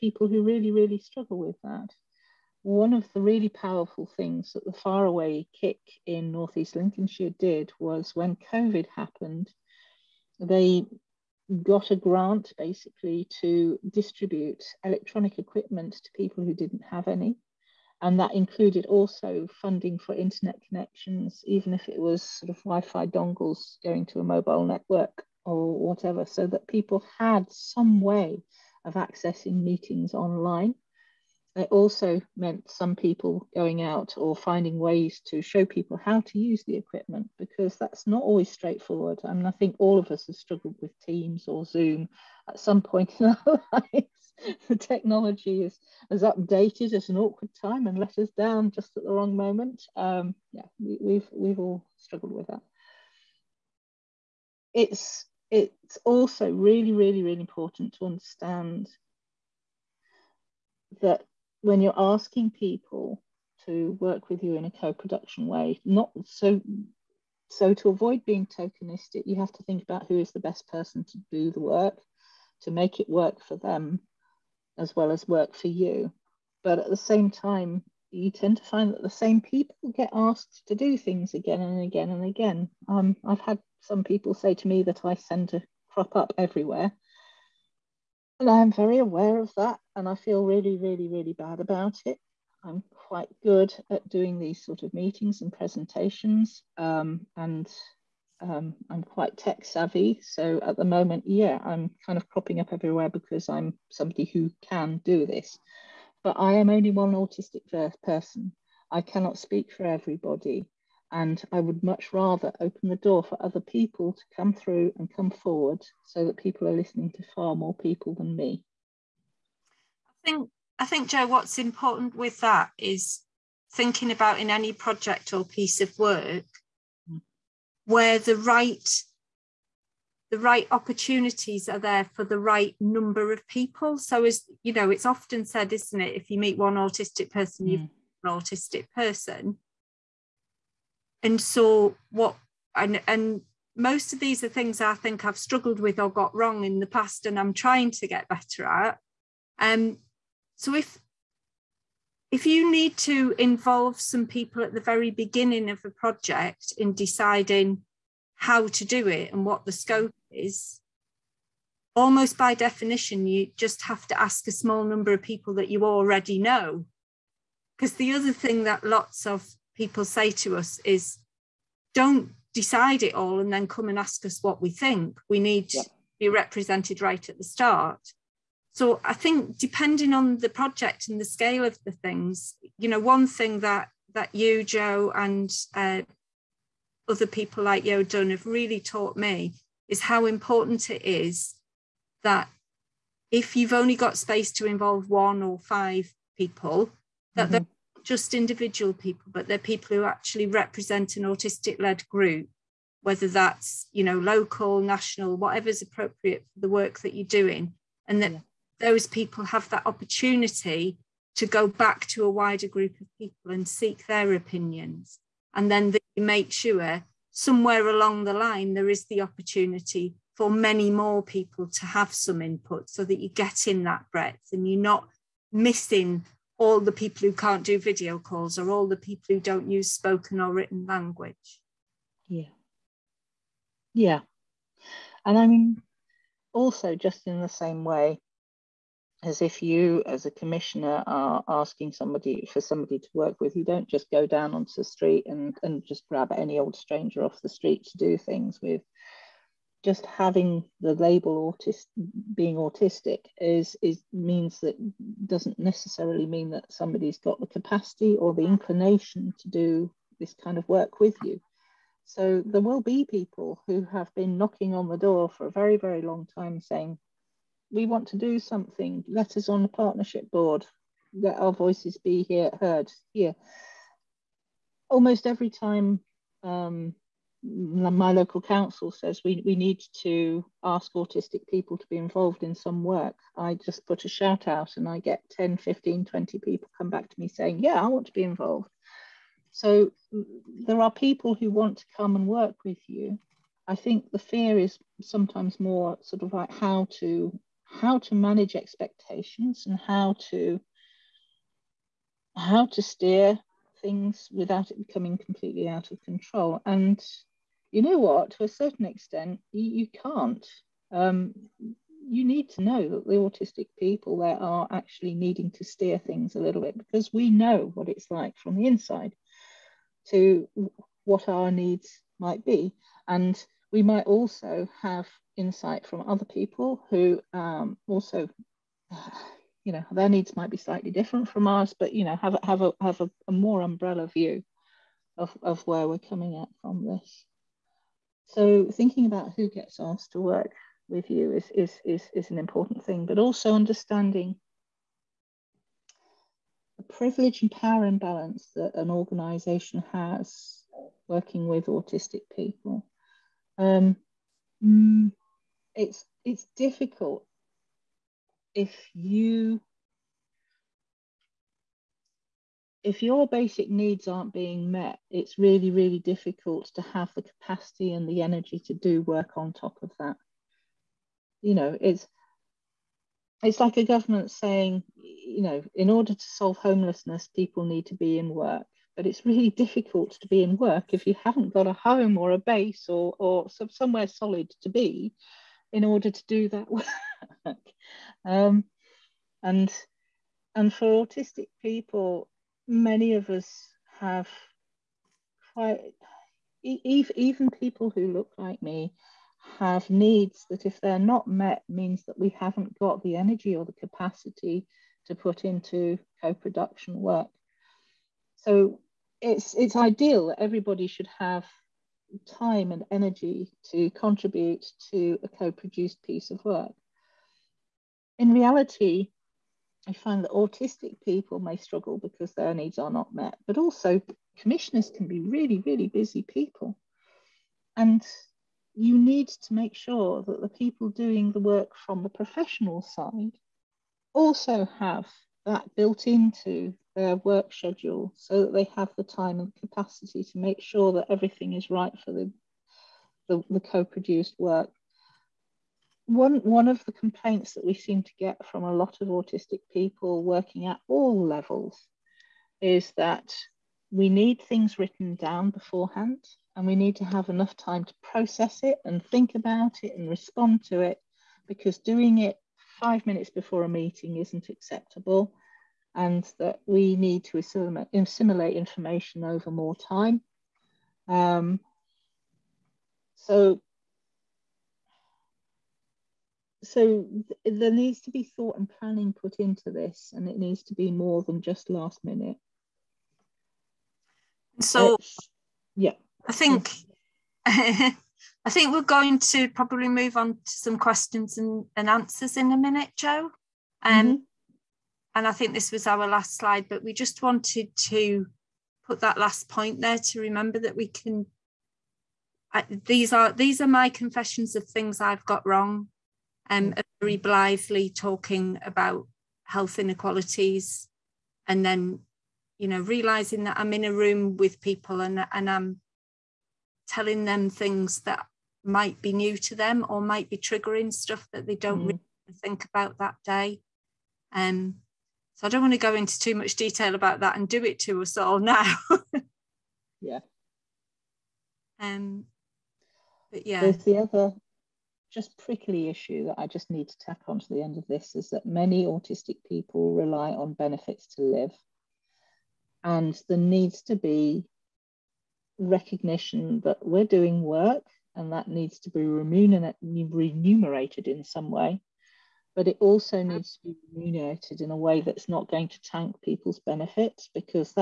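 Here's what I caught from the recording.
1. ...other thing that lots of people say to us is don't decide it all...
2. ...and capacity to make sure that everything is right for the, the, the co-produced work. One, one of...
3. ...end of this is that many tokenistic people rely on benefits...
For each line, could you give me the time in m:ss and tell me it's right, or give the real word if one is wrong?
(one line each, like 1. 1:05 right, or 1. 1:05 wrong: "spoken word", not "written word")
1. 2:48 right
2. 7:19 right
3. 8:57 wrong: "autistic", not "tokenistic".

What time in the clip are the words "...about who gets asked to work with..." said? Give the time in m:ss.
5:39.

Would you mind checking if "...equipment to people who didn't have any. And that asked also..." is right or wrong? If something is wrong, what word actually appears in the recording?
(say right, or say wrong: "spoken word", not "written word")
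wrong: "included", not "asked".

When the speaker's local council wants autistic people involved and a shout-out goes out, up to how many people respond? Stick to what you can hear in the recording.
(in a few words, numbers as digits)
20.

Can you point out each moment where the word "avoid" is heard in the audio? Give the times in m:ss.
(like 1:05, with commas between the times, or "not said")
1:07.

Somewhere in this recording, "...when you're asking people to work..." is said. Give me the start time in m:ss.
1:01.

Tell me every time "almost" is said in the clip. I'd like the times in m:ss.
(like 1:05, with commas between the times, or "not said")
2:41, 4:34.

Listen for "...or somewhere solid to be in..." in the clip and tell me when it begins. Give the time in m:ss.
6:23.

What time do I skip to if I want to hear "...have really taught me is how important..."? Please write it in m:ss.
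3:08.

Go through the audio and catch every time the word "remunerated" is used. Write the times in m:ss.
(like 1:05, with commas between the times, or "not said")
9:09, 9:13.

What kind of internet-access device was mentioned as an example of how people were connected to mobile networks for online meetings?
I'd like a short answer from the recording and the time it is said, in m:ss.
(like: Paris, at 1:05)
Wi Fi dongles, at 0:22.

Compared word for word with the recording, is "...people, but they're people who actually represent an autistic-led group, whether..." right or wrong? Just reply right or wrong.
right.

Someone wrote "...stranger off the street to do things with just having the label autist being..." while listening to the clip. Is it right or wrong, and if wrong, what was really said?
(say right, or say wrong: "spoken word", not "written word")
right.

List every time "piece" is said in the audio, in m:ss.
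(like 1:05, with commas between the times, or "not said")
2:05, 6:56.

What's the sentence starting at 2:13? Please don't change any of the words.
So as you know, it's often said, isn't it, if you meet one autistic person, you you mm.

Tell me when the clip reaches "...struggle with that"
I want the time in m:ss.
0:00.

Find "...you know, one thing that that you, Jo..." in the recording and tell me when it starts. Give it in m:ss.
3:02.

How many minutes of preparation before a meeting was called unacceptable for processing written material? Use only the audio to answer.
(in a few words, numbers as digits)
5.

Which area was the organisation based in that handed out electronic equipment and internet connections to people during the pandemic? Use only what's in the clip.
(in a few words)
Northeast Lincolnshire.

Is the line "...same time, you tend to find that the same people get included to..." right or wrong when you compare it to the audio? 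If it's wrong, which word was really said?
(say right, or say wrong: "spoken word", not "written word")
wrong: "asked", not "included".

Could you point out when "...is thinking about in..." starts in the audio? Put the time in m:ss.
2:02.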